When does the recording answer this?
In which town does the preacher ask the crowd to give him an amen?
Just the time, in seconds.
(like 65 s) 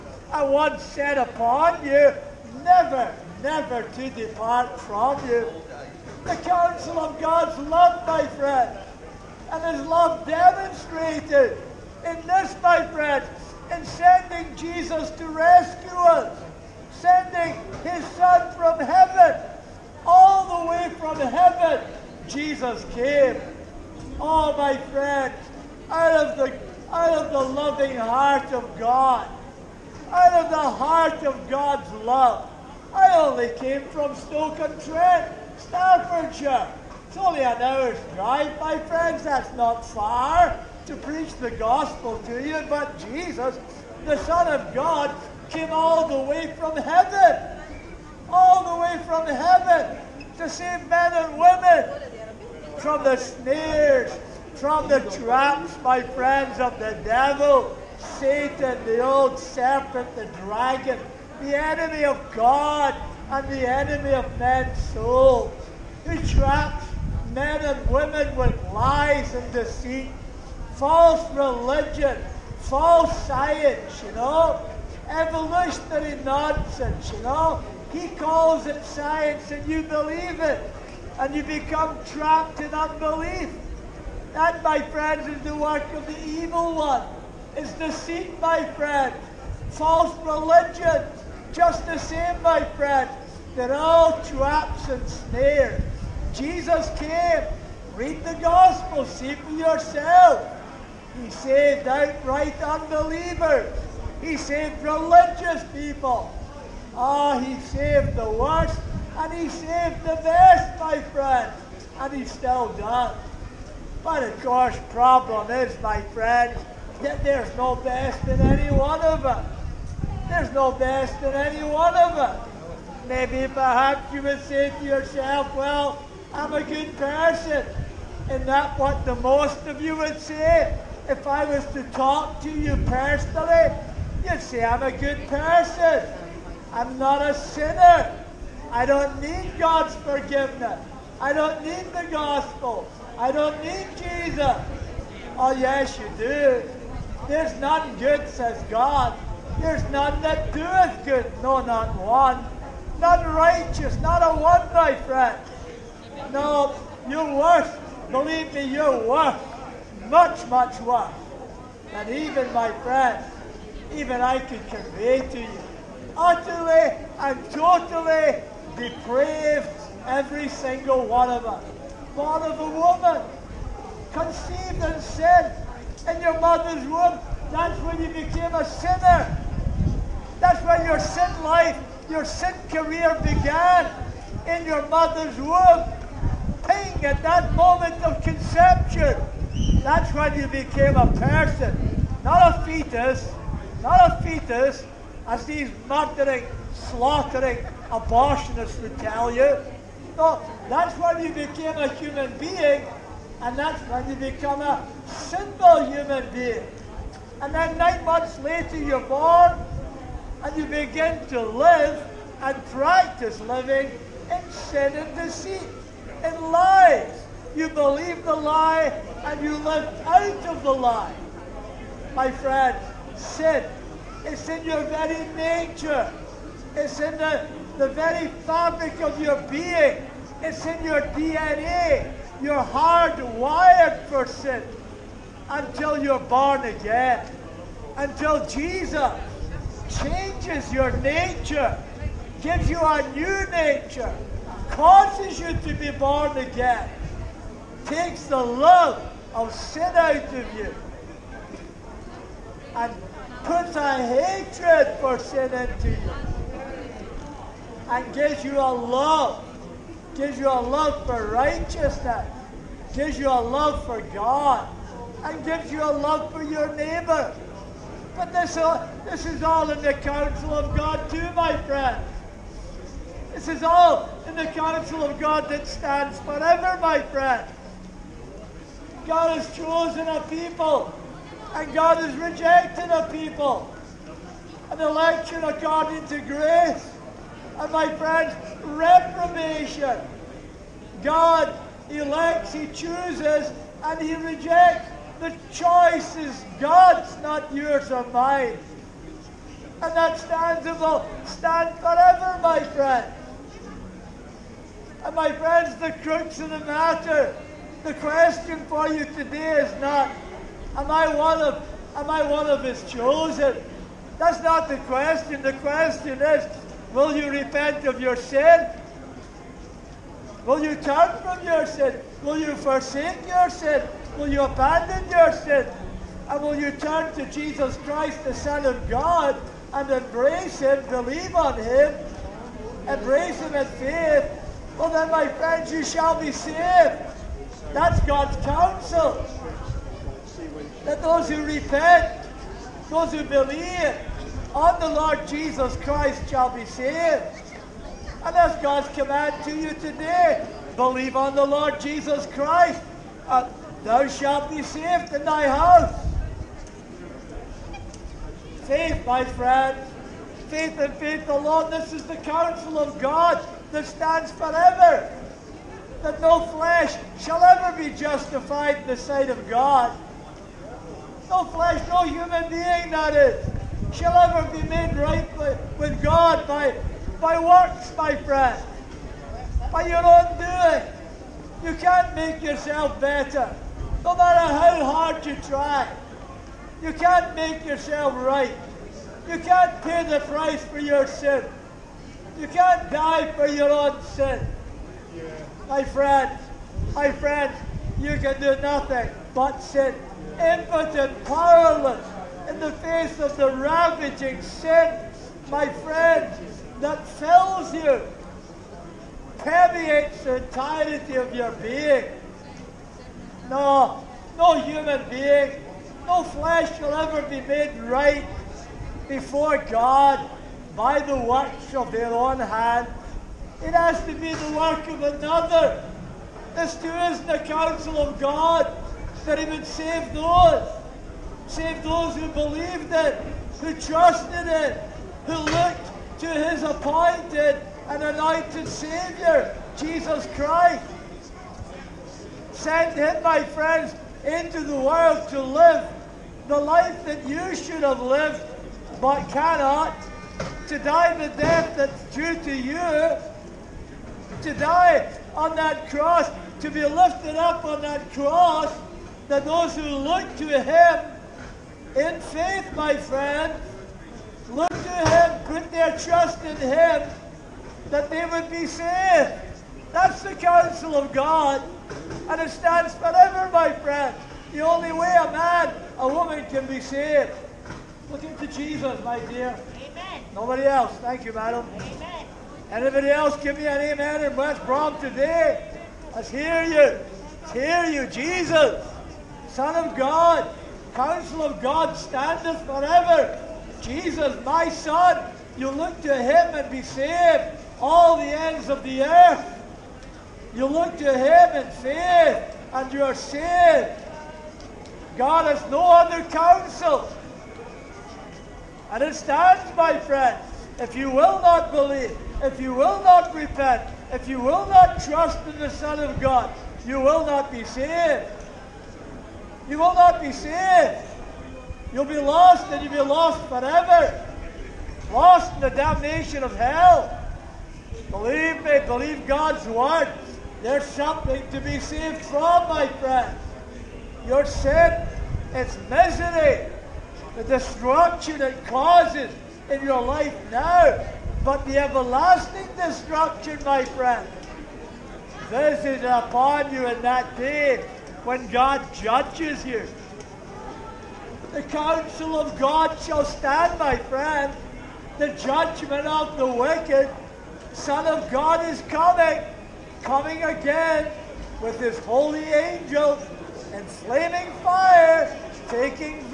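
484 s.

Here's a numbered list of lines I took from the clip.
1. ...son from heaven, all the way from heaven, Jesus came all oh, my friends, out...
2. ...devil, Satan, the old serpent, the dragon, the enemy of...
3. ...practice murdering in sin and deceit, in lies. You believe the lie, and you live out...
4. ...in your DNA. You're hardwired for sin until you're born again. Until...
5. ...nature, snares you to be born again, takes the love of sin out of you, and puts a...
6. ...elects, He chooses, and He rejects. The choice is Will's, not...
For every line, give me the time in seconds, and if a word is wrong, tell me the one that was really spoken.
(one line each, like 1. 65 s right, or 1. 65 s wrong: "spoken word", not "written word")
1. 18 s right
2. 57 s right
3. 212 s wrong: "living", not "murdering"
4. 230 s right
5. 243 s wrong: "causes", not "snares"
6. 291 s wrong: "God", not "Will".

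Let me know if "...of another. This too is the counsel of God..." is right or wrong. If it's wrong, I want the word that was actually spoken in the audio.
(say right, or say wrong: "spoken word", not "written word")
right.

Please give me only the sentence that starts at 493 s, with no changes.
Jesus, my son, you look to him and be saved.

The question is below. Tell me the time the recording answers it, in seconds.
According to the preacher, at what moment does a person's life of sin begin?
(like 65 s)
188 s.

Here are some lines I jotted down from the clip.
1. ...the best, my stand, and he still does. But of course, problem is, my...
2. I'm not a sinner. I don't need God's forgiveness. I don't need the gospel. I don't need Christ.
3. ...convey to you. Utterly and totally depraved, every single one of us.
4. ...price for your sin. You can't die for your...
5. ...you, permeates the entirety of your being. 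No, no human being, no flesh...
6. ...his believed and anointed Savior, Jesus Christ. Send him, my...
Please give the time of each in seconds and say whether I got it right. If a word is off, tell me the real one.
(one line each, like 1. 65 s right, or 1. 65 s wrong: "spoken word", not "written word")
1. 110 s wrong: "friend", not "stand"
2. 136 s wrong: "Jesus", not "Christ"
3. 164 s right
4. 390 s right
5. 407 s right
6. 436 s wrong: "appointed", not "believed".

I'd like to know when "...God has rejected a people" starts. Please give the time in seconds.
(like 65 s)
281 s.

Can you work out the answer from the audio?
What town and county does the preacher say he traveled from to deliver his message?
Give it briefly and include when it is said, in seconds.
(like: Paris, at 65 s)
Stoke-on-Trent, Staffordshire, at 34 s.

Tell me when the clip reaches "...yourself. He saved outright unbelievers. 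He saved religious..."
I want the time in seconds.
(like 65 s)
99 s.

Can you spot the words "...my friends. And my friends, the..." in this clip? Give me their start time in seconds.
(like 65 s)
302 s.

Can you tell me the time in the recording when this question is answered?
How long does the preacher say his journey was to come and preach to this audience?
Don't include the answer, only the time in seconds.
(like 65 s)
37 s.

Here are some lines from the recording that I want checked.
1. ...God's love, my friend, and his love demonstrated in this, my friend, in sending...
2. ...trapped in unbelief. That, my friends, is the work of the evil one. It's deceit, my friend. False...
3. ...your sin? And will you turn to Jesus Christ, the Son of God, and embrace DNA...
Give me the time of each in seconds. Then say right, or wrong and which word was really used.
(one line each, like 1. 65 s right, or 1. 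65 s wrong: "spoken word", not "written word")
1. 7 s right
2. 82 s right
3. 325 s wrong: "Him", not "DNA".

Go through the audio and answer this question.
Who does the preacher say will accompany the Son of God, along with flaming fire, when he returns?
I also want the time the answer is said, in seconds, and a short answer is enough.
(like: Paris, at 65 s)
his holy angels, at 561 s.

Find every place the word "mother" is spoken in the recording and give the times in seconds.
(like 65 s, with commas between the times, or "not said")
176 s, 184 s.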